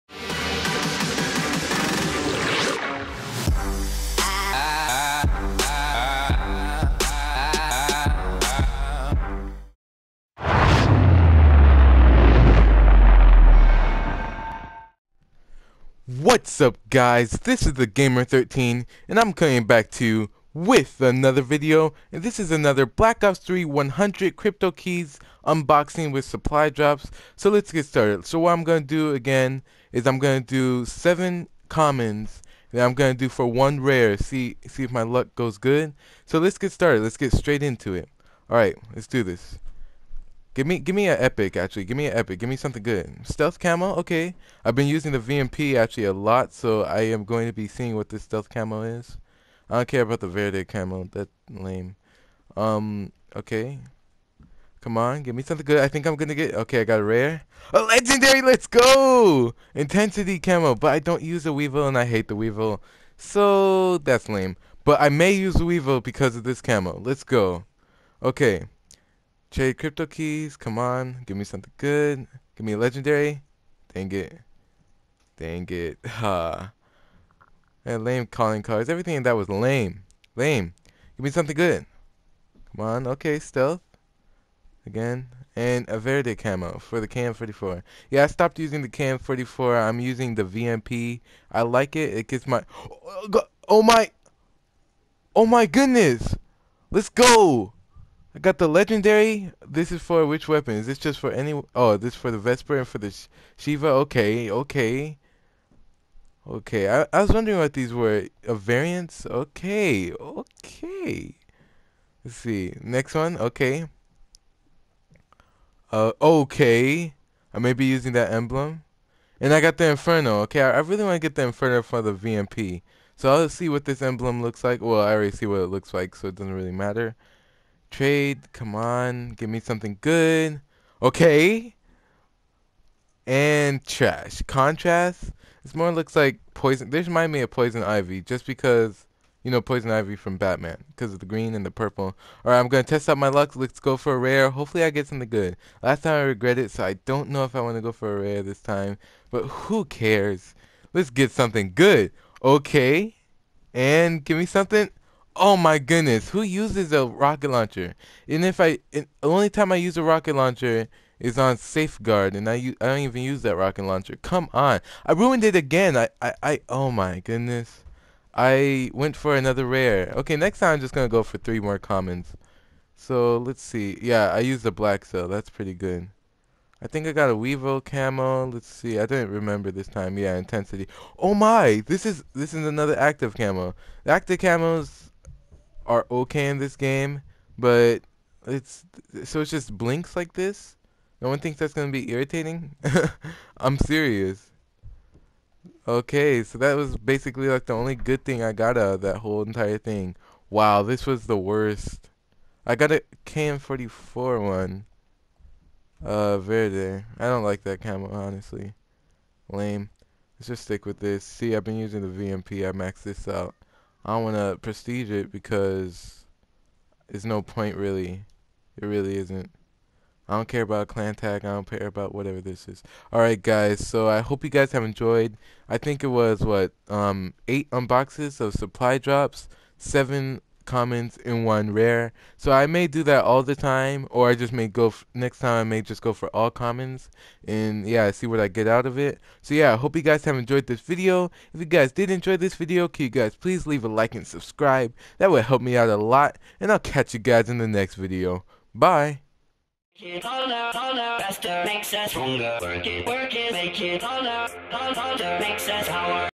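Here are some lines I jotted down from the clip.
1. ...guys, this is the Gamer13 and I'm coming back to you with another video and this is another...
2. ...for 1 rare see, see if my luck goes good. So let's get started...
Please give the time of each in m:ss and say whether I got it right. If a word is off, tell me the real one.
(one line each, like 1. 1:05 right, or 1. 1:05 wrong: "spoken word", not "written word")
1. 0:16 right
2. 0:33 right.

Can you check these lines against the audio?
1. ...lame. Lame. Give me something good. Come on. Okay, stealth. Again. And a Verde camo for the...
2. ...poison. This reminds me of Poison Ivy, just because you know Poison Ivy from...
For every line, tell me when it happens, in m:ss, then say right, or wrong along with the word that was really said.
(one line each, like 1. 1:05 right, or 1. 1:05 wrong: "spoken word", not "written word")
1. 1:19 right
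2. 2:16 right.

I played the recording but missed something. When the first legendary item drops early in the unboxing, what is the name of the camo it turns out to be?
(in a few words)
Intensity camo.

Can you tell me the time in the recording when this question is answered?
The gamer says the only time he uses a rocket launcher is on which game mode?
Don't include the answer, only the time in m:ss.
2:41.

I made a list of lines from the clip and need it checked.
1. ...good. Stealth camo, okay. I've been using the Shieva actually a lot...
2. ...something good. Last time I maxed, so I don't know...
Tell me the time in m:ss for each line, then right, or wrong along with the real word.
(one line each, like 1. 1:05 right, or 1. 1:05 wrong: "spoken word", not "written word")
1. 0:42 wrong: "VMP", not "Shieva"
2. 2:25 wrong: "regretted", not "maxed".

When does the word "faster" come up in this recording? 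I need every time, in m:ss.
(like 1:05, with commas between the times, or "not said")
4:10.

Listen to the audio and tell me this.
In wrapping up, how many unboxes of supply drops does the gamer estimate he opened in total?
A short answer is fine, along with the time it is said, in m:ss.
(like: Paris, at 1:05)
8, at 3:47.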